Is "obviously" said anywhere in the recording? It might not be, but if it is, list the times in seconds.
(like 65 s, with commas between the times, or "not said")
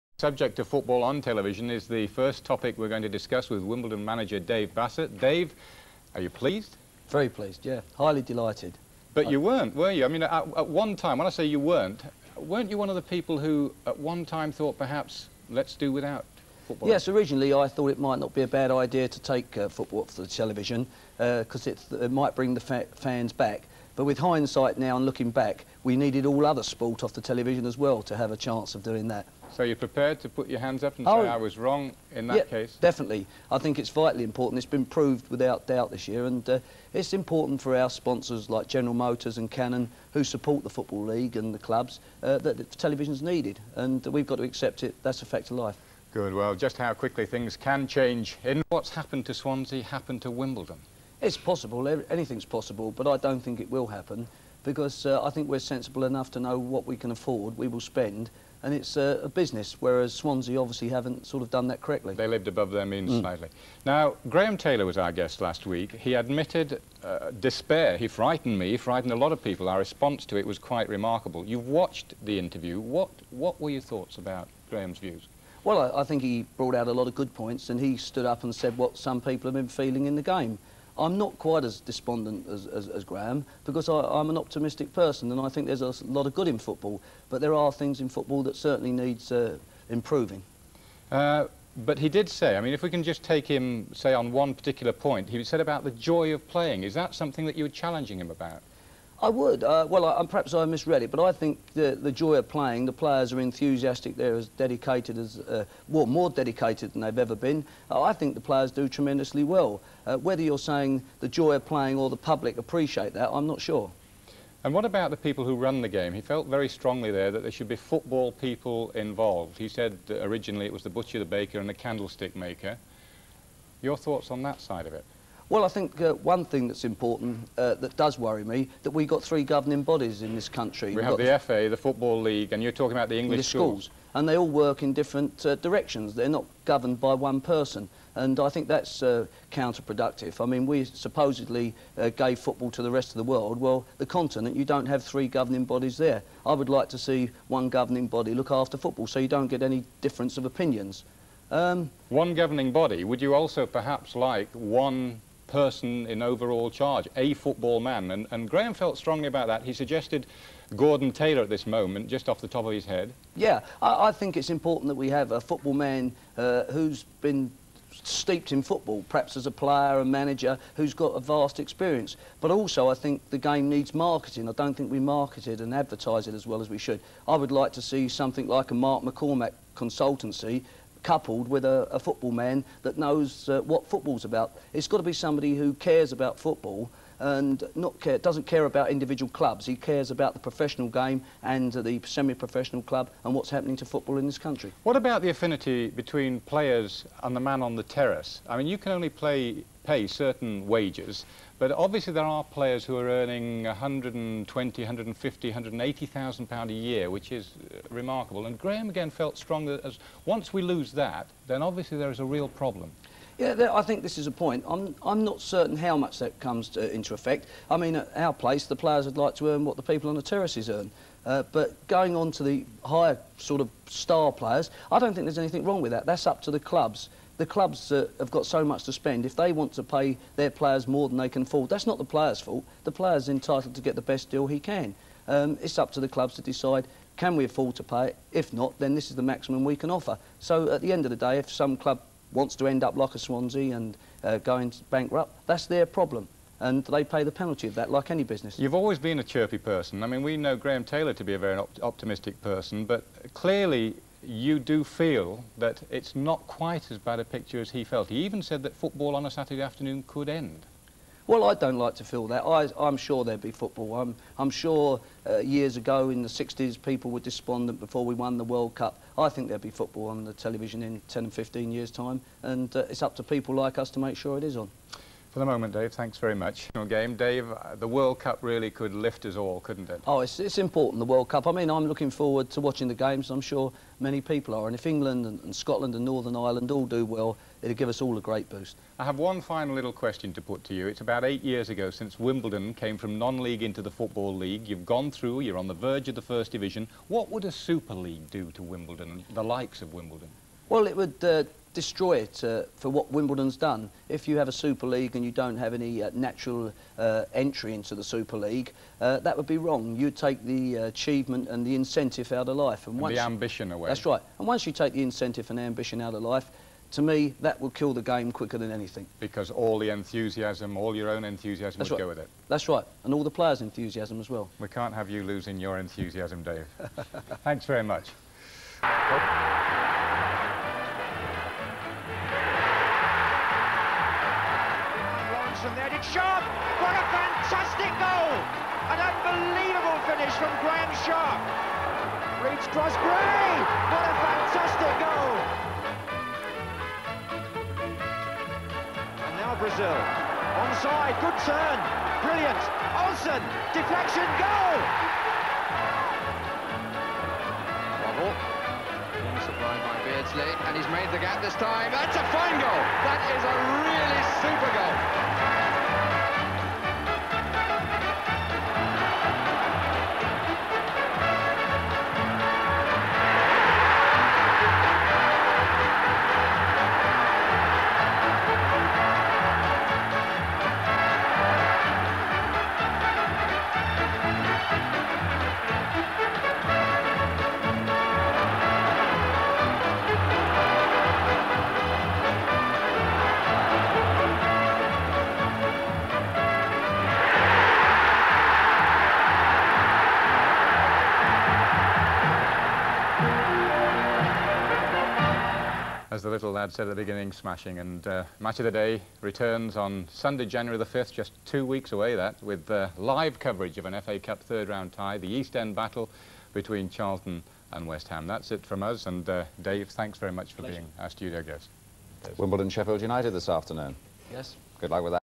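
60 s, 201 s, 211 s.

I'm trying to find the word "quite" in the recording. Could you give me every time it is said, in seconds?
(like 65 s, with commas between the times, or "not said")
70 s, 81 s, 256 s.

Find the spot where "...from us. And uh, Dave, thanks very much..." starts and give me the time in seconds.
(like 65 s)
418 s.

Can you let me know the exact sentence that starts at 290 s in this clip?
It's about eight years ago since Wimbledon came from non-league into the Football League.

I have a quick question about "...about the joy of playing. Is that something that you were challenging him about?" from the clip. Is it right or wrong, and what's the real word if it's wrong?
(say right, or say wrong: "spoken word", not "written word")
right.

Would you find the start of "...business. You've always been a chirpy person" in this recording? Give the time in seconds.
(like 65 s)
248 s.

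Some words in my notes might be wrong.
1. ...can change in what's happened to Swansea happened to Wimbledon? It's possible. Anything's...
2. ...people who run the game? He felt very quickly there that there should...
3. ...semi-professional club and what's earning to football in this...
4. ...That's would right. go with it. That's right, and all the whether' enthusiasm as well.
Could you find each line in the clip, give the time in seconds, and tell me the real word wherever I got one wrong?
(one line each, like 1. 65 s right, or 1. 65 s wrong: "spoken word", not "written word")
1. 47 s right
2. 115 s wrong: "strongly", not "quickly"
3. 192 s wrong: "happening", not "earning"
4. 321 s wrong: "players", not "whether".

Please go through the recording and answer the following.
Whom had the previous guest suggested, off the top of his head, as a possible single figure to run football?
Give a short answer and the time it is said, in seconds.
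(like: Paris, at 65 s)
Gordon Taylor, at 160 s.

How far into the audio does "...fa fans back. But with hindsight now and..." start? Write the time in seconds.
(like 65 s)
22 s.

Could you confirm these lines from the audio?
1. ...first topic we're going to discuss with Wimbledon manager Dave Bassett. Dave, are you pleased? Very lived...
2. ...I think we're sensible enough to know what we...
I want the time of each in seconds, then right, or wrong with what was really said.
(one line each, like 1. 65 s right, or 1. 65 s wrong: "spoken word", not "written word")
1. 2 s wrong: "pleased", not "lived"
2. 55 s right.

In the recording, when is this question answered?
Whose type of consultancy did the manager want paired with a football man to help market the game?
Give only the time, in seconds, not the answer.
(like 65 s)
178 s.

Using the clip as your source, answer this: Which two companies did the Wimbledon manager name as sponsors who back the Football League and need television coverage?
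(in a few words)
General Motors and Canon.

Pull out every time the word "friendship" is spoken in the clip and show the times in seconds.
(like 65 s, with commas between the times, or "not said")
not said.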